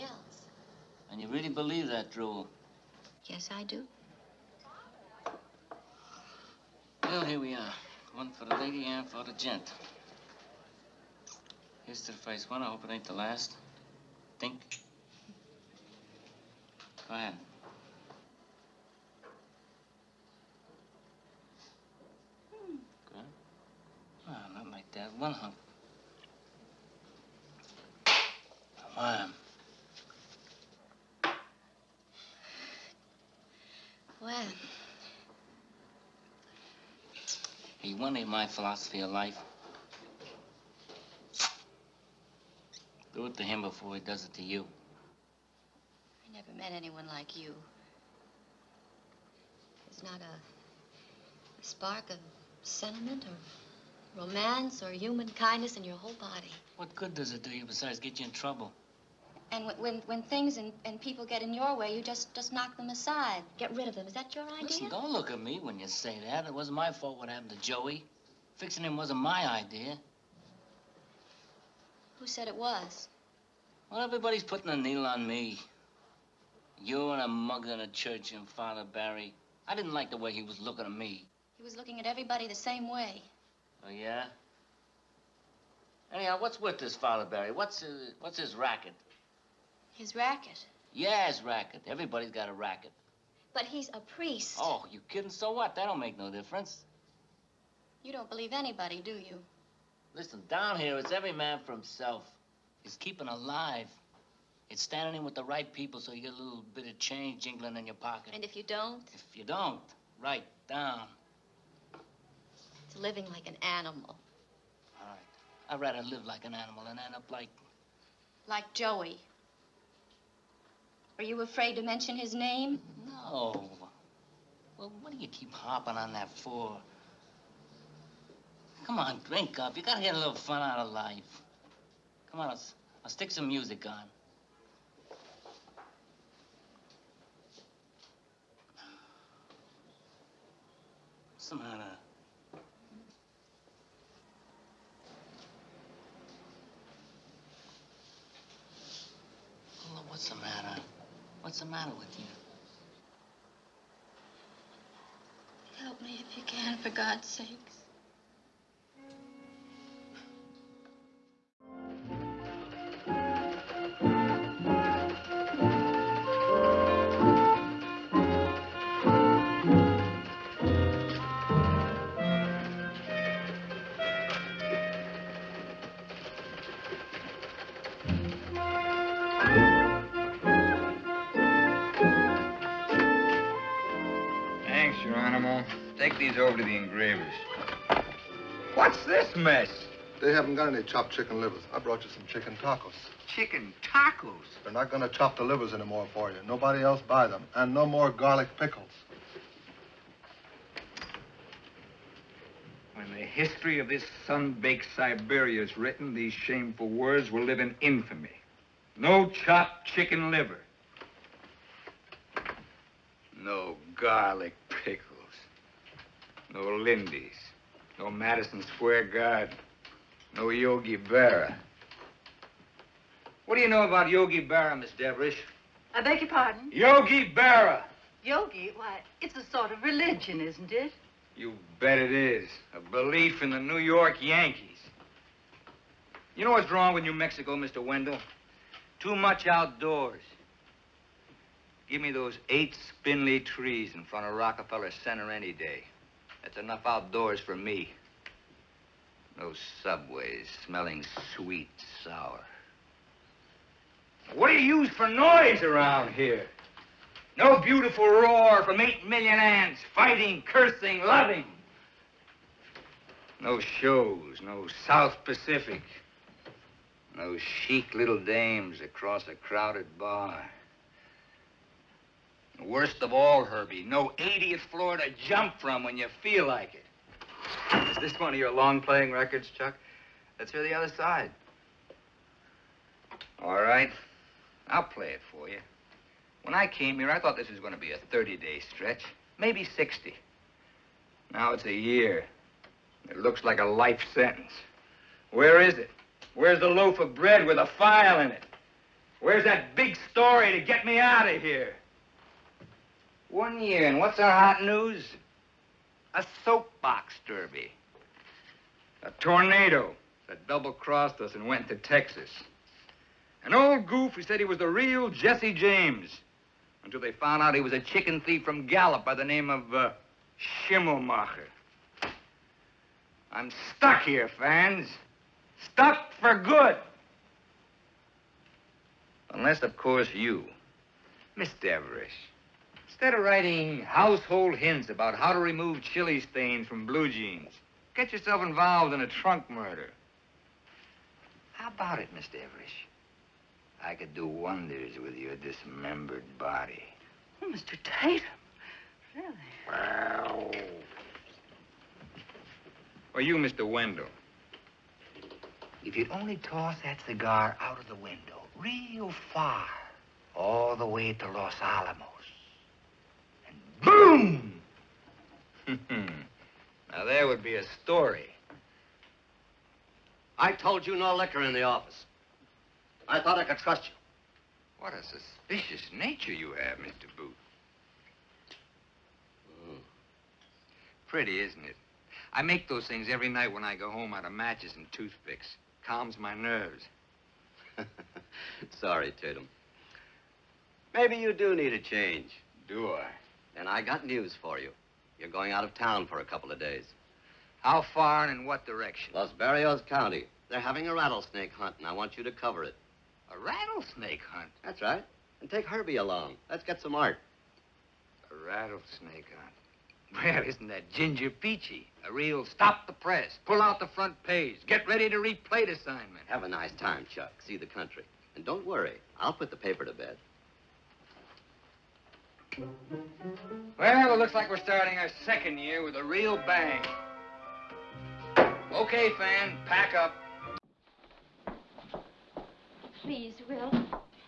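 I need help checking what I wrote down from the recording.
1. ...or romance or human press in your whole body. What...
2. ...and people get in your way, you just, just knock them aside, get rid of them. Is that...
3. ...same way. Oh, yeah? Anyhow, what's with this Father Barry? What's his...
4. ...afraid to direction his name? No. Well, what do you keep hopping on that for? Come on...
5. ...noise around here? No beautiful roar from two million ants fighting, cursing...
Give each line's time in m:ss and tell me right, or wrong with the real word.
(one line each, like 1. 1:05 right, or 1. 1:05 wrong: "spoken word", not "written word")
1. 0:53 wrong: "kindness", not "press"
2. 1:00 right
3. 1:22 right
4. 2:01 wrong: "mention", not "direction"
5. 4:15 wrong: "eight", not "two".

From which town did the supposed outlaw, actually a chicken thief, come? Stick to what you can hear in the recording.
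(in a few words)
Gallup.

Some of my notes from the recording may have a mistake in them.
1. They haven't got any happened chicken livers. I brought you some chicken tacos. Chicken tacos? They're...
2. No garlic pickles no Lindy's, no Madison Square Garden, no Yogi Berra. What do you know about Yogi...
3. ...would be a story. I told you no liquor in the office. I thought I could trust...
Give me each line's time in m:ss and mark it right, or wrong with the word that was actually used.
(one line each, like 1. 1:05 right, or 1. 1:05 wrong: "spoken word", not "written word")
1. 3:10 wrong: "chopped", not "happened"
2. 3:33 right
3. 6:07 right.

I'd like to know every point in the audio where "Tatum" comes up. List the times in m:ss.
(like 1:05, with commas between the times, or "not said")
5:47, 6:29.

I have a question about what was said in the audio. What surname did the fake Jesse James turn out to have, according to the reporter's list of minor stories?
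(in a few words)
Schimmelmacher.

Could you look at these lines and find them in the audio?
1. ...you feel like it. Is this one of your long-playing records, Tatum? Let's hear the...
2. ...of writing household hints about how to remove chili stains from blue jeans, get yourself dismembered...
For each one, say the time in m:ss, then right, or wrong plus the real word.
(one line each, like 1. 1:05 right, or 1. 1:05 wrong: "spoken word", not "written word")
1. 4:35 wrong: "Chuck", not "Tatum"
2. 5:33 wrong: "involved", not "dismembered".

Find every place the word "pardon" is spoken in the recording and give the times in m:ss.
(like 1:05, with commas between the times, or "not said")
3:46.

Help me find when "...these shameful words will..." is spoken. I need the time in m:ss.
3:26.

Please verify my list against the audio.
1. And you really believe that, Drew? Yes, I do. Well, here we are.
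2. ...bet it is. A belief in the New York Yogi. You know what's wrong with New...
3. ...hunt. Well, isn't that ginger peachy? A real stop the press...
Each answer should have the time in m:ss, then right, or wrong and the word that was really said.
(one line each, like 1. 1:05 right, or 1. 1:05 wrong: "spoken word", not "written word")
1. 0:01 right
2. 3:51 wrong: "Yankees", not "Yogi"
3. 6:49 right.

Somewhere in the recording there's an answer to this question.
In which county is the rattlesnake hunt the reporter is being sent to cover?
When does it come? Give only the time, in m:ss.
6:39.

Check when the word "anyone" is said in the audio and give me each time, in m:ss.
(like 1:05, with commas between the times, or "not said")
0:46.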